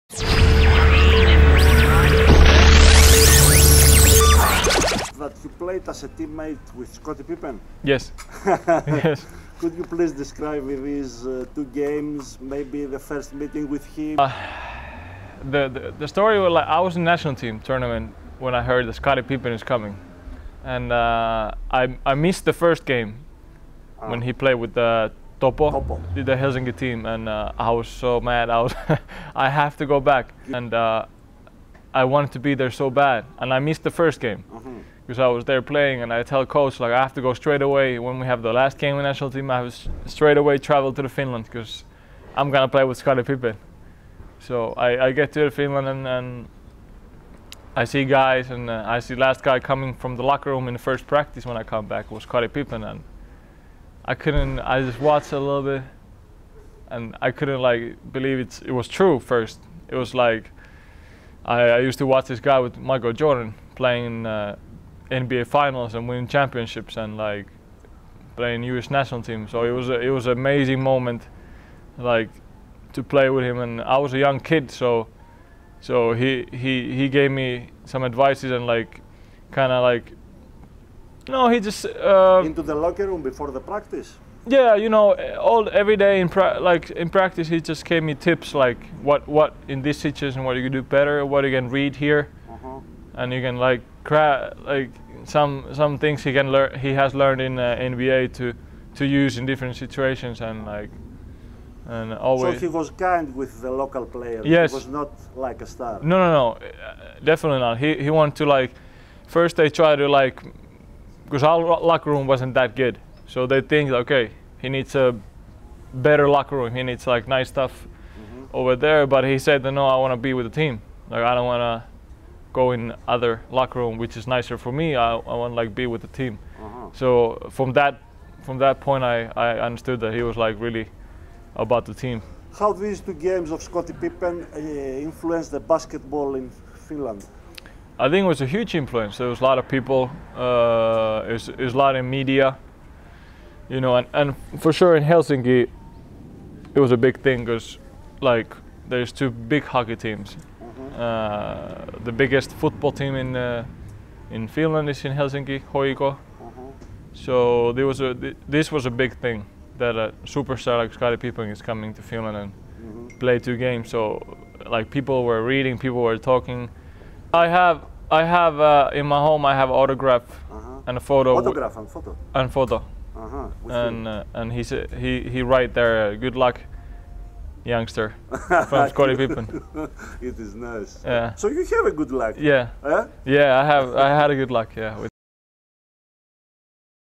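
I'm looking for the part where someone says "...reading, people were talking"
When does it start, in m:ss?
2:45.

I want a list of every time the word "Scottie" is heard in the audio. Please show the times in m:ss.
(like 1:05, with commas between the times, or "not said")
0:06, 0:18, 0:42, 0:52, 2:13, 2:40, 2:58.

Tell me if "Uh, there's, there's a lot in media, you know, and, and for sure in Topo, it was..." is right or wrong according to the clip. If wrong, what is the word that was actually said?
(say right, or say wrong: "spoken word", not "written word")
wrong: "Helsinki", not "Topo".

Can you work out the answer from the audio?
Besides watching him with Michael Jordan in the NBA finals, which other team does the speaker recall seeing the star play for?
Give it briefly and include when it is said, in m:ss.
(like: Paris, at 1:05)
US national team, at 1:08.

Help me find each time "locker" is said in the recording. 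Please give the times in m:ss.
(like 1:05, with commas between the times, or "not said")
0:50, 1:22, 1:51, 1:56, 2:03.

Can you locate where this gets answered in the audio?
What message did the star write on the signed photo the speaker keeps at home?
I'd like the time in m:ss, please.
2:56.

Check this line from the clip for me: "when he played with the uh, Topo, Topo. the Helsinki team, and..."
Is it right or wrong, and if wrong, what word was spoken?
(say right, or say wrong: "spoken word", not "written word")
right.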